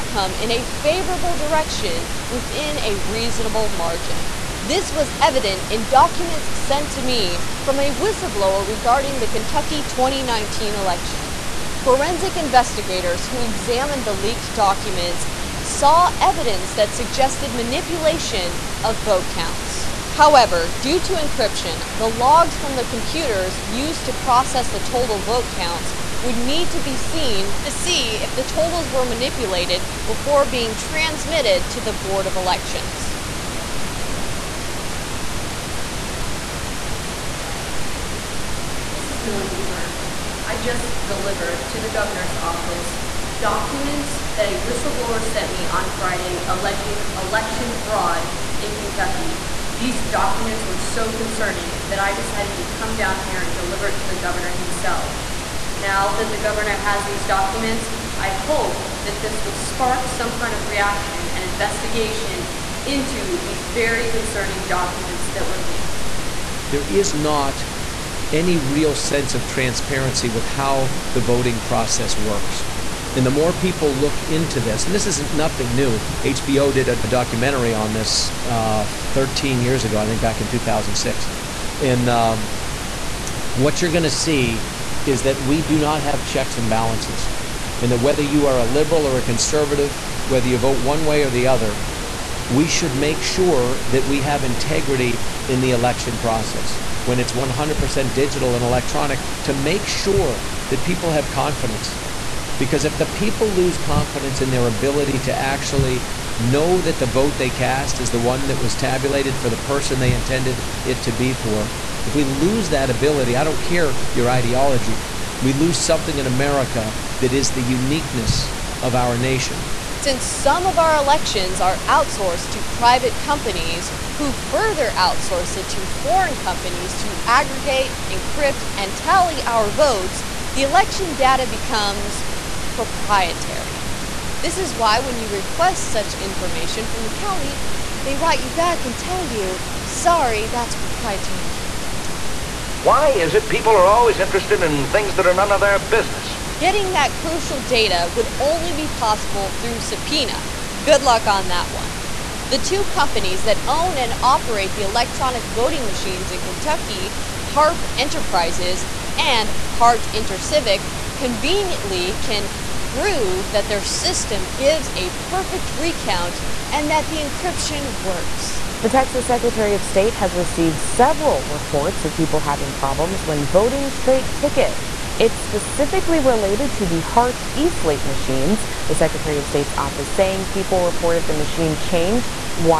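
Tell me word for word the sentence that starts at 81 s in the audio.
And um, what you're going to see is that we do not have checks and balances.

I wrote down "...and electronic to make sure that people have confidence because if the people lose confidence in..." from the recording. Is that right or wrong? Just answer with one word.
right.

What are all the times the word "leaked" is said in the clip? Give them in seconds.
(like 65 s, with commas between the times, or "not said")
14 s, 65 s.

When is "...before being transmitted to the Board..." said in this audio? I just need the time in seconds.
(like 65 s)
30 s.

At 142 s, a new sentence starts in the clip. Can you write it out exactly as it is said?
Why is it people are always interested in things that are none of their business?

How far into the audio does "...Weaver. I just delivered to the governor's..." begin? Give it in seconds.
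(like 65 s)
39 s.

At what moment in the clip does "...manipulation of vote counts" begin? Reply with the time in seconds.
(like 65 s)
17 s.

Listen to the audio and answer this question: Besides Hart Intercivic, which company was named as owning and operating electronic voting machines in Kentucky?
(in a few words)
Harp Enterprises.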